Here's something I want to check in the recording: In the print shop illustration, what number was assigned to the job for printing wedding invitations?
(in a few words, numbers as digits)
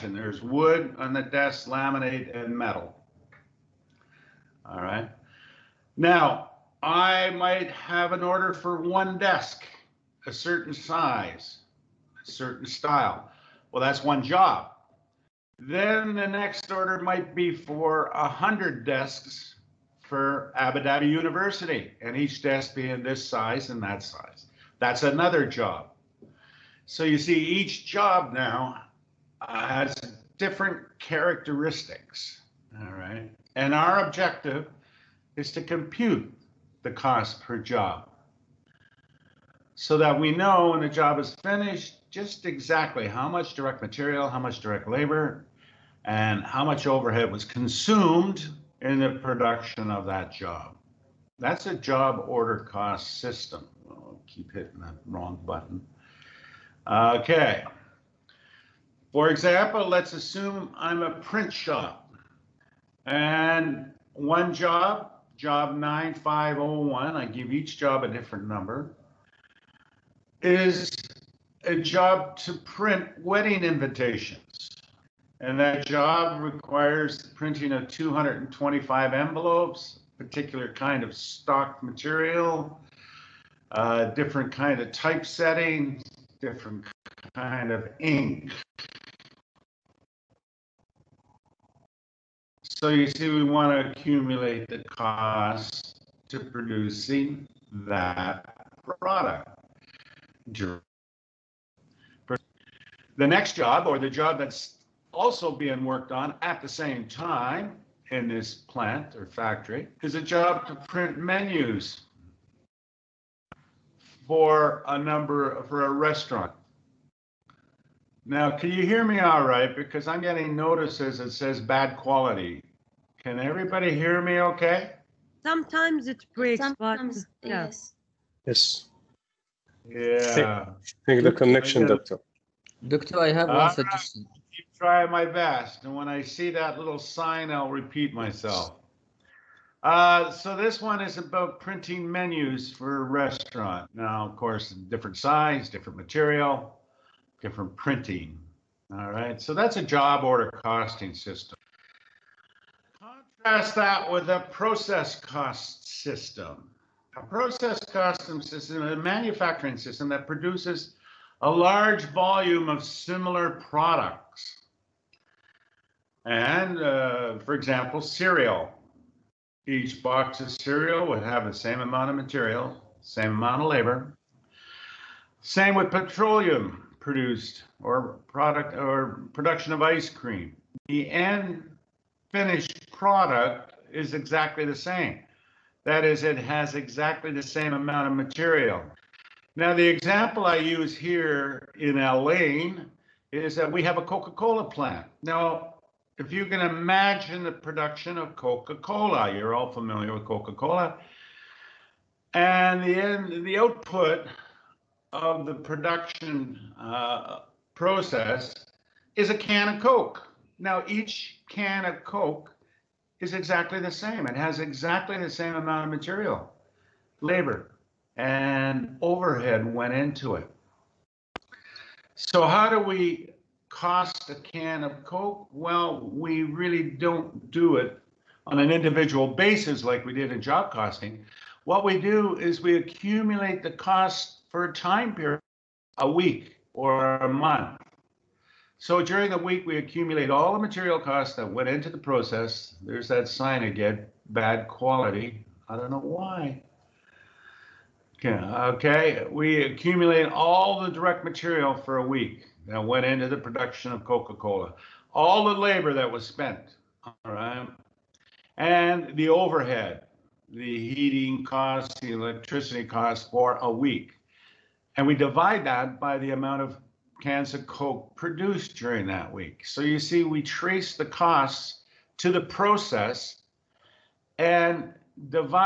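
9501.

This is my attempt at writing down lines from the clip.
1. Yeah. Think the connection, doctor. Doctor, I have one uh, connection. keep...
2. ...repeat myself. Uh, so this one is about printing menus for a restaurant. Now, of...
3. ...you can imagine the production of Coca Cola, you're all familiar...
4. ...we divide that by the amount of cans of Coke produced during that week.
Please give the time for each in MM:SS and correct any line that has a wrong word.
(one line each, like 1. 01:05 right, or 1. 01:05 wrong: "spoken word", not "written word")
1. 02:09 wrong: "suggestion", not "connection"
2. 02:17 right
3. 03:16 right
4. 04:25 right.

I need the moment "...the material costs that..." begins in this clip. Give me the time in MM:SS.
04:00.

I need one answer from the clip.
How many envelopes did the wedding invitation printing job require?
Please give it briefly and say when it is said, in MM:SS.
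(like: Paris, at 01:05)
225, at 01:17.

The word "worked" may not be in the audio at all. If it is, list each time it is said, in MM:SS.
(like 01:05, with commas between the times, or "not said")
01:45.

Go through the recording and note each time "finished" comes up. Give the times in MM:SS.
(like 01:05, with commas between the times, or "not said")
00:41, 03:02.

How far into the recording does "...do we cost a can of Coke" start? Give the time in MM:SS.
03:42.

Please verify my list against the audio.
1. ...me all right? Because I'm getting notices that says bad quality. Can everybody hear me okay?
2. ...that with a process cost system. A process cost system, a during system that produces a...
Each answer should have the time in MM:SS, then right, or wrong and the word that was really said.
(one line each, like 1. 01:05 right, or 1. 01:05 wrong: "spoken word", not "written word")
1. 01:59 right
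2. 02:33 wrong: "manufacturing", not "during".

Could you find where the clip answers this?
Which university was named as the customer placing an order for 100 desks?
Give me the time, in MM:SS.
00:20.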